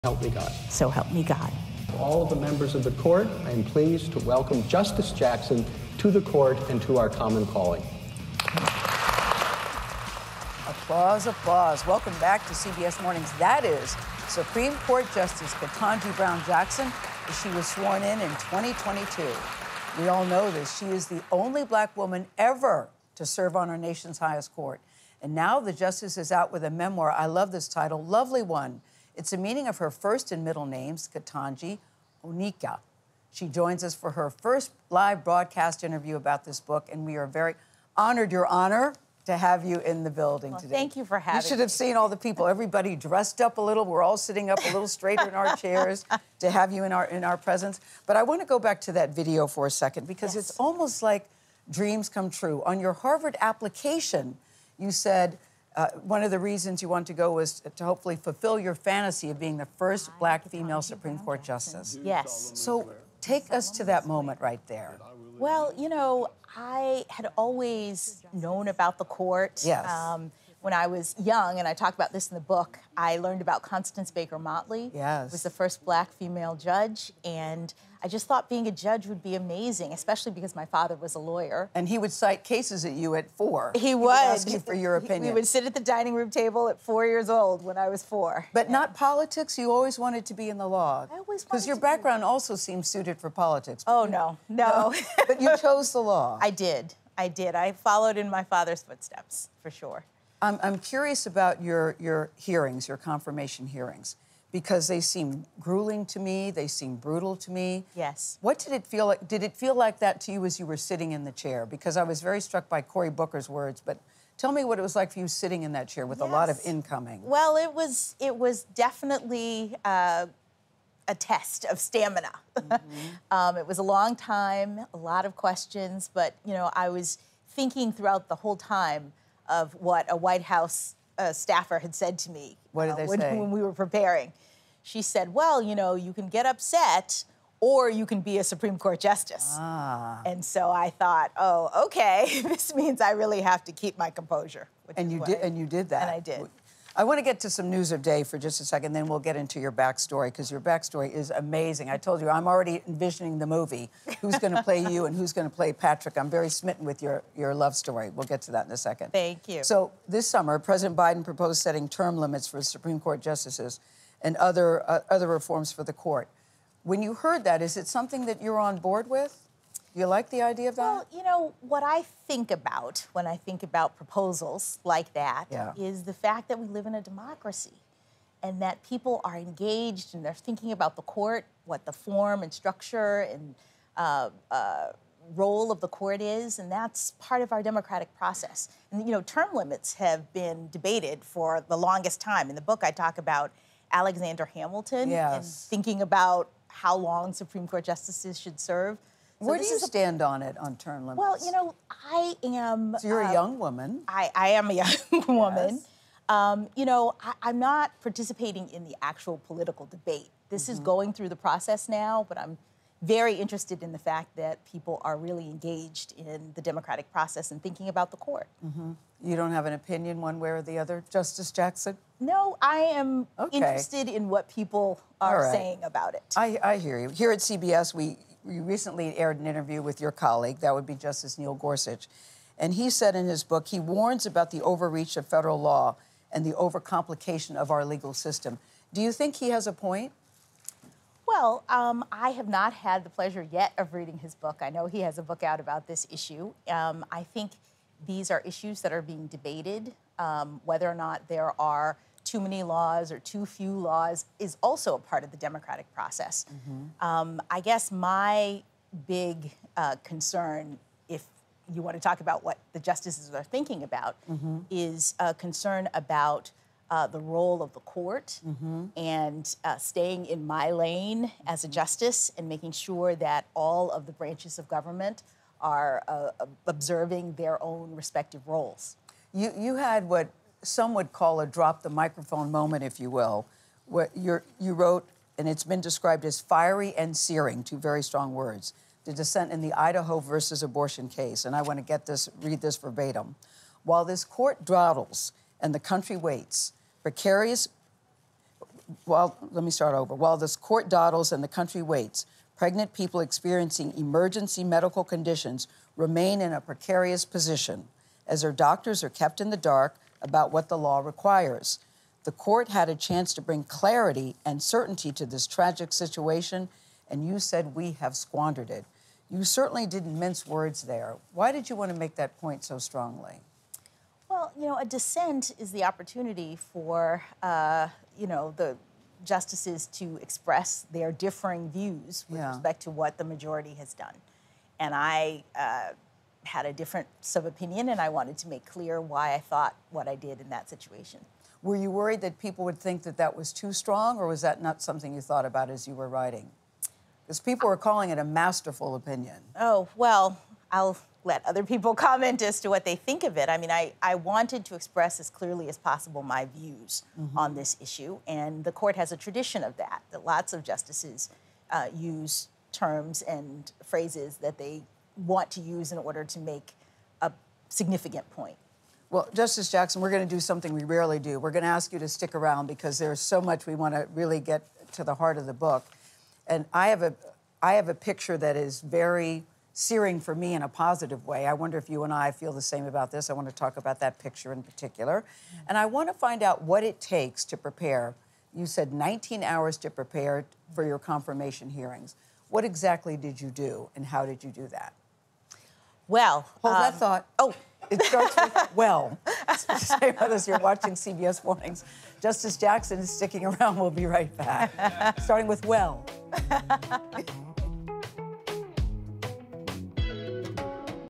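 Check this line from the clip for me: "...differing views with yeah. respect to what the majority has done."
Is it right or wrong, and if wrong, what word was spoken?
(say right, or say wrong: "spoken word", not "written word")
right.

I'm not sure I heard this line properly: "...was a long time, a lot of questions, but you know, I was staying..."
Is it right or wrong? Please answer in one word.
wrong.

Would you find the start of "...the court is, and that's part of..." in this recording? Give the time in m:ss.
3:05.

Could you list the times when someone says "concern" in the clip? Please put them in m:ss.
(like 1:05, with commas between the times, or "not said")
4:20, 4:25.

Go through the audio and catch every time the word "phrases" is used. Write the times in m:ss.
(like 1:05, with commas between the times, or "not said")
6:03.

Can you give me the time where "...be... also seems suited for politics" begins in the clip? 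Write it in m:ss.
1:32.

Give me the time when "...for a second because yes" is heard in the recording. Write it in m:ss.
0:49.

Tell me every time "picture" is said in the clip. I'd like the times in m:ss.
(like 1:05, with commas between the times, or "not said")
6:17, 6:24.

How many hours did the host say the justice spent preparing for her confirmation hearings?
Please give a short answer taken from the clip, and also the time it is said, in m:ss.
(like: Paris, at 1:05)
19, at 6:28.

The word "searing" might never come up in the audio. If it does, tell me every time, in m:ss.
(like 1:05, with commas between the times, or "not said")
4:47, 6:19.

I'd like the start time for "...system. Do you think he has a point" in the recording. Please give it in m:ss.
3:58.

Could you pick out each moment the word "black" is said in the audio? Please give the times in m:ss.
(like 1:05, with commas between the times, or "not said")
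0:21, 1:00, 1:15.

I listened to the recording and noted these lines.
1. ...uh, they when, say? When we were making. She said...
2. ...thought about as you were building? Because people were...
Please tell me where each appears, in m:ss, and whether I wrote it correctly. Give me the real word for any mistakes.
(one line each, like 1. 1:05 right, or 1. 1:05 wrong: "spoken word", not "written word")
1. 2:12 wrong: "preparing", not "making"
2. 5:45 wrong: "writing", not "building".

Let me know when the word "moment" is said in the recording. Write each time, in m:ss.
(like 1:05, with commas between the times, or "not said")
1:04, 4:42.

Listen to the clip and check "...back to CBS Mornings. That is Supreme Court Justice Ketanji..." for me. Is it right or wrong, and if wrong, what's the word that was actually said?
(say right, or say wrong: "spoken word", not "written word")
right.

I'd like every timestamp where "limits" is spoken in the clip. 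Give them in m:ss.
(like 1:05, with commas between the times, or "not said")
2:42, 3:09, 3:21.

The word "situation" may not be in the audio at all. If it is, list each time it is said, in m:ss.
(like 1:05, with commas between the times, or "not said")
5:15, 5:40.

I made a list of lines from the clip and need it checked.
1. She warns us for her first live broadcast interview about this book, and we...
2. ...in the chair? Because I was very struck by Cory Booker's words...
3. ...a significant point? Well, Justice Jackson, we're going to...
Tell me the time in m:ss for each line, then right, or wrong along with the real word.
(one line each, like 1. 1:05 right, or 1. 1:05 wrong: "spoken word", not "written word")
1. 0:33 wrong: "joins", not "warns"
2. 1:51 right
3. 6:07 right.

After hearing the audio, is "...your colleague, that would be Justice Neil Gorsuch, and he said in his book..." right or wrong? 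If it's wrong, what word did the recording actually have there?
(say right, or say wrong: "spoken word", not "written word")
right.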